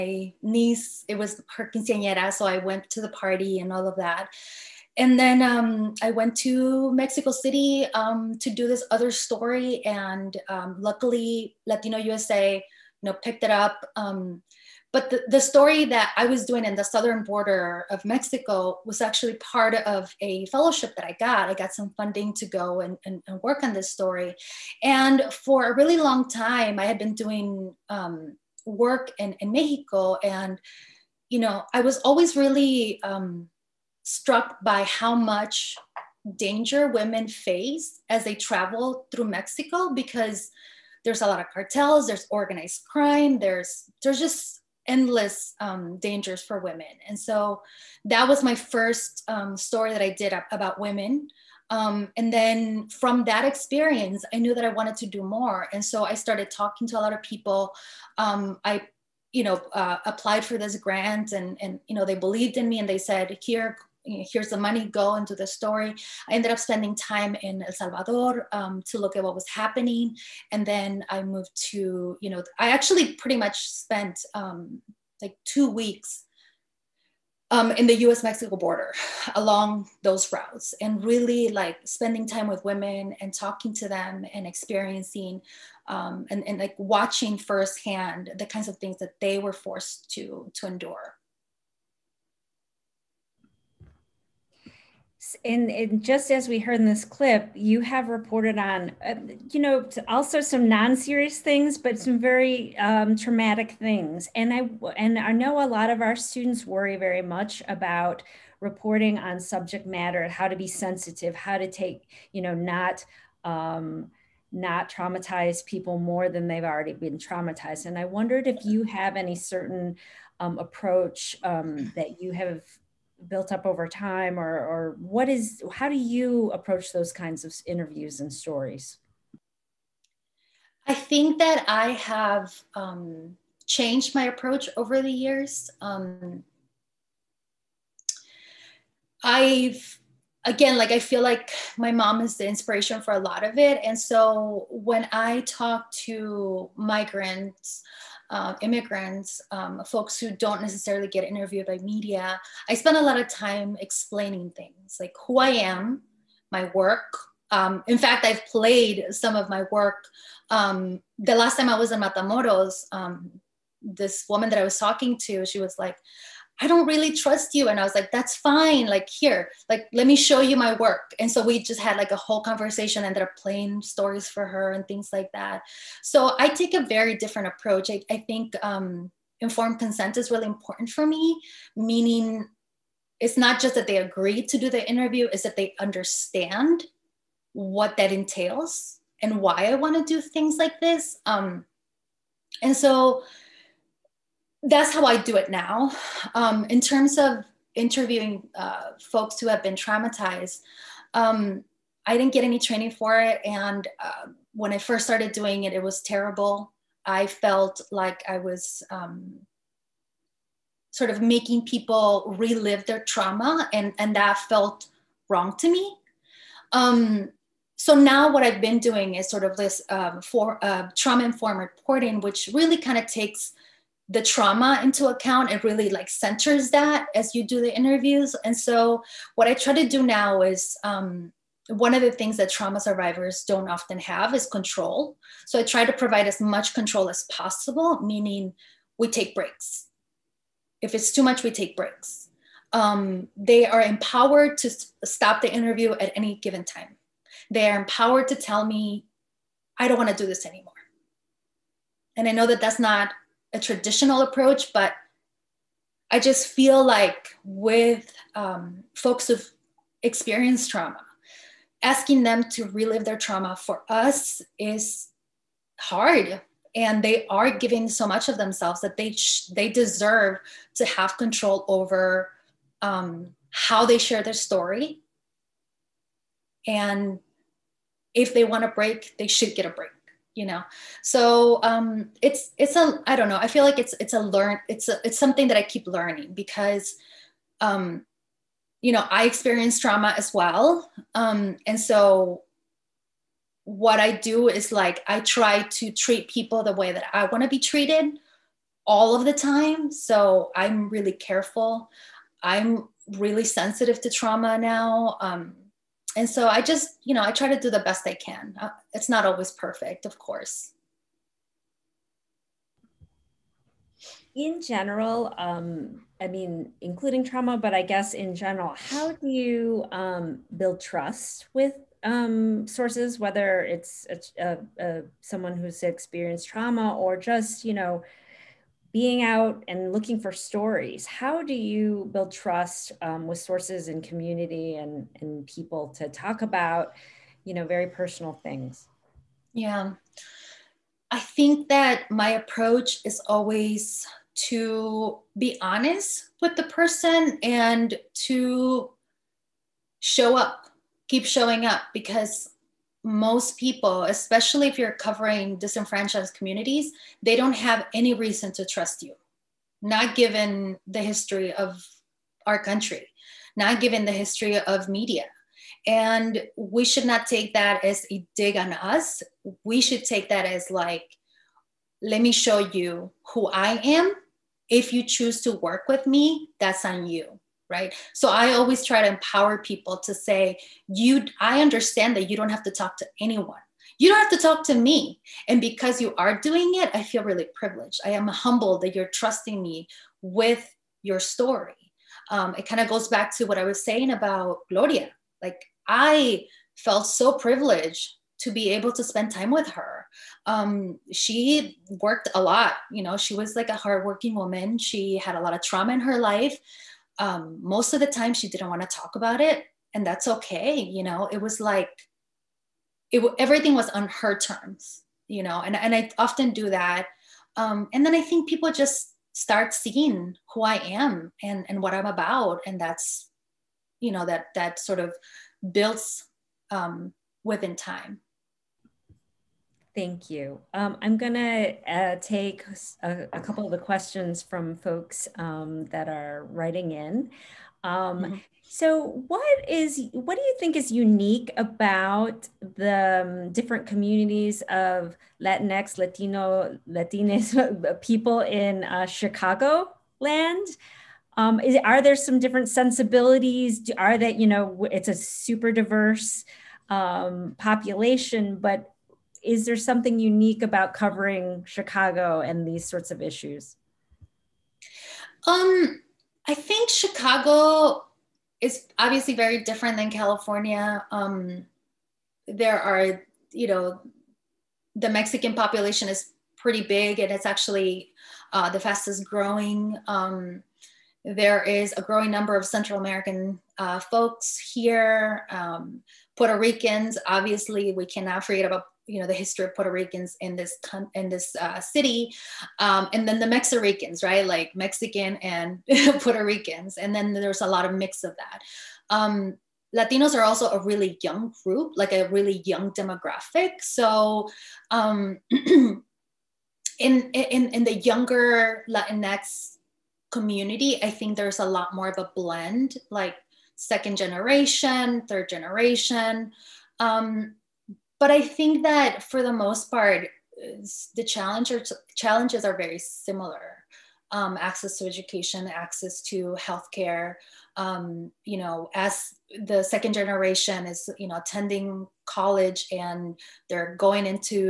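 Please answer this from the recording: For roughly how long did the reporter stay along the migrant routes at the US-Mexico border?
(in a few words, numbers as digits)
2 weeks.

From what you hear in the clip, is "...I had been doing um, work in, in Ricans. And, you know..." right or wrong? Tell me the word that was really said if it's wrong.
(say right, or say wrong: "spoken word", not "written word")
wrong: "Mexico", not "Ricans".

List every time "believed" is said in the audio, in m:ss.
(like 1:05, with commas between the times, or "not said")
1:02.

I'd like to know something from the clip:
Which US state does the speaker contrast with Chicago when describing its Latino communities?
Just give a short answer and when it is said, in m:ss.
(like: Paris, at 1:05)
California, at 7:50.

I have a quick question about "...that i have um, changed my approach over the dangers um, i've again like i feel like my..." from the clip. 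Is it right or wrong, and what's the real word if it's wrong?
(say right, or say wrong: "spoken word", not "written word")
wrong: "years", not "dangers".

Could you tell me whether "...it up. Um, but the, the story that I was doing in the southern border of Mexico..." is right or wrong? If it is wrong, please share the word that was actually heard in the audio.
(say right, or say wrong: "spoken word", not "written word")
right.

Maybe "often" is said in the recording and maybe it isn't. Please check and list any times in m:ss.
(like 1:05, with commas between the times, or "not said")
3:53, 6:56.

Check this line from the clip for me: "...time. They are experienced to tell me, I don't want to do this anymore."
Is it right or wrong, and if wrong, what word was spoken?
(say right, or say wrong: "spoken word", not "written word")
wrong: "empowered", not "experienced".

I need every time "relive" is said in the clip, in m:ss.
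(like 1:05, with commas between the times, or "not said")
3:32, 4:22.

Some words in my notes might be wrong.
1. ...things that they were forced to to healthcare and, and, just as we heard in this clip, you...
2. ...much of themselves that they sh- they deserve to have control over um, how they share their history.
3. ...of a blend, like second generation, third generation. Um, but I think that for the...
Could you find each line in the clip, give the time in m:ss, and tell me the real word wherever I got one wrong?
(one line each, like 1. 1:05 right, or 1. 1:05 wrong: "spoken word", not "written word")
1. 1:28 wrong: "endure", not "healthcare"
2. 4:28 wrong: "story", not "history"
3. 8:32 right.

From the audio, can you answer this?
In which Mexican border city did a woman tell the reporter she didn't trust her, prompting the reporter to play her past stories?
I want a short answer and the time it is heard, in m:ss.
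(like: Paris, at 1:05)
Matamoros, at 2:42.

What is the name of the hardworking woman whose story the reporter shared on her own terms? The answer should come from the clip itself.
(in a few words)
Gloria.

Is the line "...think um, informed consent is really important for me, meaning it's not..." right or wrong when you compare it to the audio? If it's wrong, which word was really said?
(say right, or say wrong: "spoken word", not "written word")
right.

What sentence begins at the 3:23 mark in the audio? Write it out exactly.
And uh, when I first started doing it, it was terrible.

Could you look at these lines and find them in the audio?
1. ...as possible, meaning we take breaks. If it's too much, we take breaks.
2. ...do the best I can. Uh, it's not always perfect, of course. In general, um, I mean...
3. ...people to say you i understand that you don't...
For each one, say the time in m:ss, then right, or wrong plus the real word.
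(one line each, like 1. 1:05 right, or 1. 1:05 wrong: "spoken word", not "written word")
1. 3:57 right
2. 5:07 right
3. 6:19 right.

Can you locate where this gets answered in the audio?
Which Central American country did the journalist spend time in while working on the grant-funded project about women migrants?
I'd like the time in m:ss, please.
1:07.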